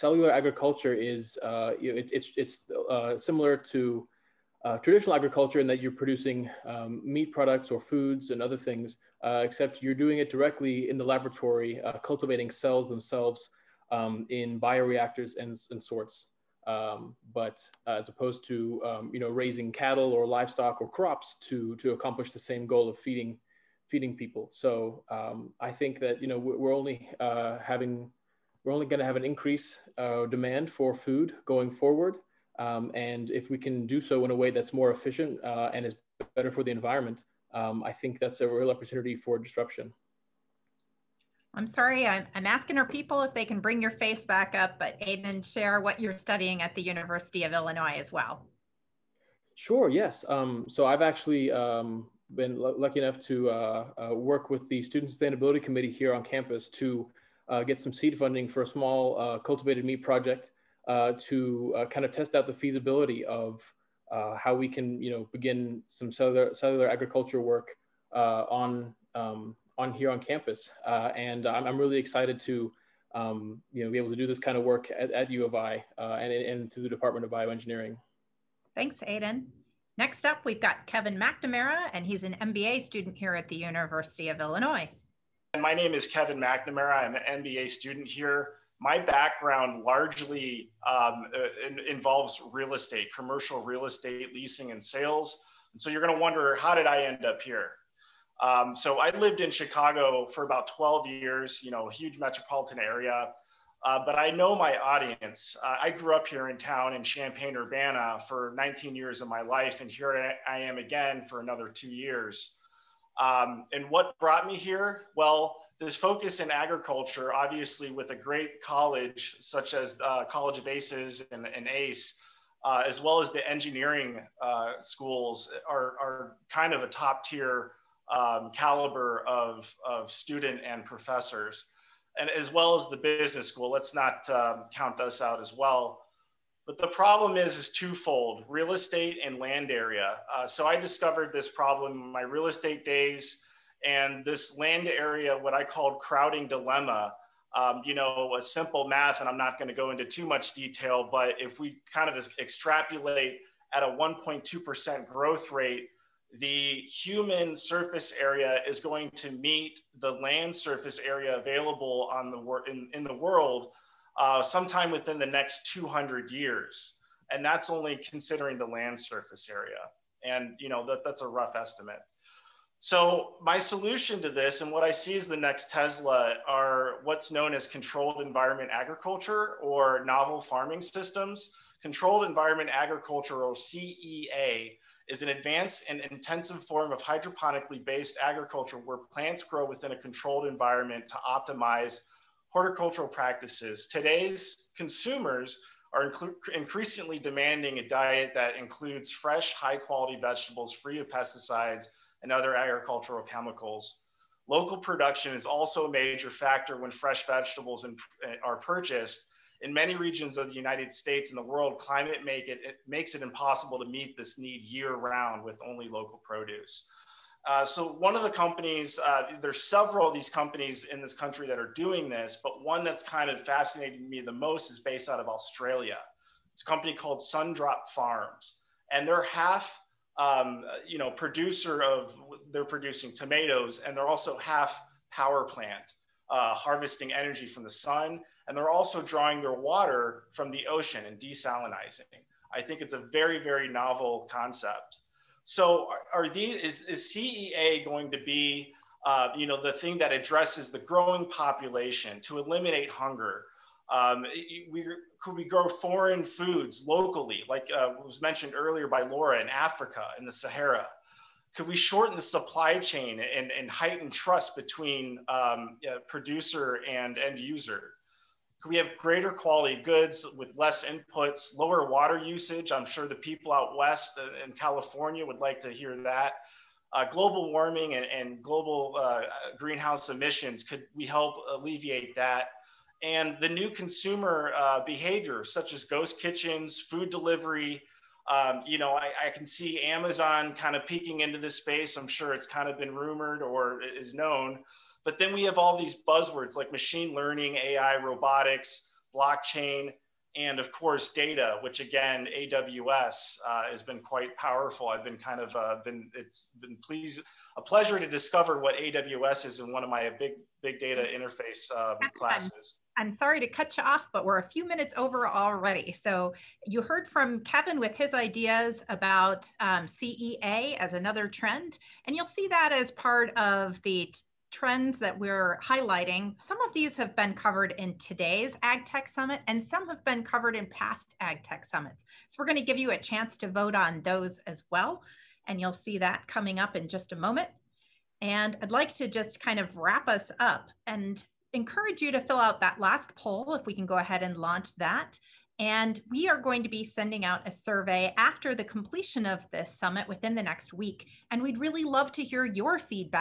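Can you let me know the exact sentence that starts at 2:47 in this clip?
And that's only considering the land surface area.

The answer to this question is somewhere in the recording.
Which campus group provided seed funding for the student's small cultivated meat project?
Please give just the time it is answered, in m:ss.
0:54.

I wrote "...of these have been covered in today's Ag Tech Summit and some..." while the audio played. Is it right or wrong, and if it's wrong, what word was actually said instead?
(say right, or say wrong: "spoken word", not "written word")
right.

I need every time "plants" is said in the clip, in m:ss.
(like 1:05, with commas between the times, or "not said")
3:08, 3:55.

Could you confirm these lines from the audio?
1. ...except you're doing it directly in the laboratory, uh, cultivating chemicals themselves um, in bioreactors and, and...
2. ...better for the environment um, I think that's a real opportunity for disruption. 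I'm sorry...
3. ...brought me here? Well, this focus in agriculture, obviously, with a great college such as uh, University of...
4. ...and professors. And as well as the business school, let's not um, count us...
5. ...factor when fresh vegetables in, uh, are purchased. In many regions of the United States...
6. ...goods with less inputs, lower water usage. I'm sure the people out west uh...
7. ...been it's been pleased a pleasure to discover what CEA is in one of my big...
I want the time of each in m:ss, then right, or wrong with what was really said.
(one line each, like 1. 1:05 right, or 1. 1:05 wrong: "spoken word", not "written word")
1. 0:09 wrong: "cells", not "chemicals"
2. 0:36 right
3. 1:54 wrong: "College", not "University"
4. 2:10 right
5. 3:26 right
6. 4:29 right
7. 5:05 wrong: "AWS", not "CEA".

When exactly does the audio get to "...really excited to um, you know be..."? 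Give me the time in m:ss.
1:11.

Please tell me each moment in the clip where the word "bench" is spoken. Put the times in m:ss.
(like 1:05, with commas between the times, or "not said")
not said.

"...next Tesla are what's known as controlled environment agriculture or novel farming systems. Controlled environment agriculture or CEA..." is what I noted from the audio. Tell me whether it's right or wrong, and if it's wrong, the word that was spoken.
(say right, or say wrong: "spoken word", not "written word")
right.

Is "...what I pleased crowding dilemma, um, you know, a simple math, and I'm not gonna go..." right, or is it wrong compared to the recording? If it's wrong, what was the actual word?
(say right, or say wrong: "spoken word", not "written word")
wrong: "called", not "pleased".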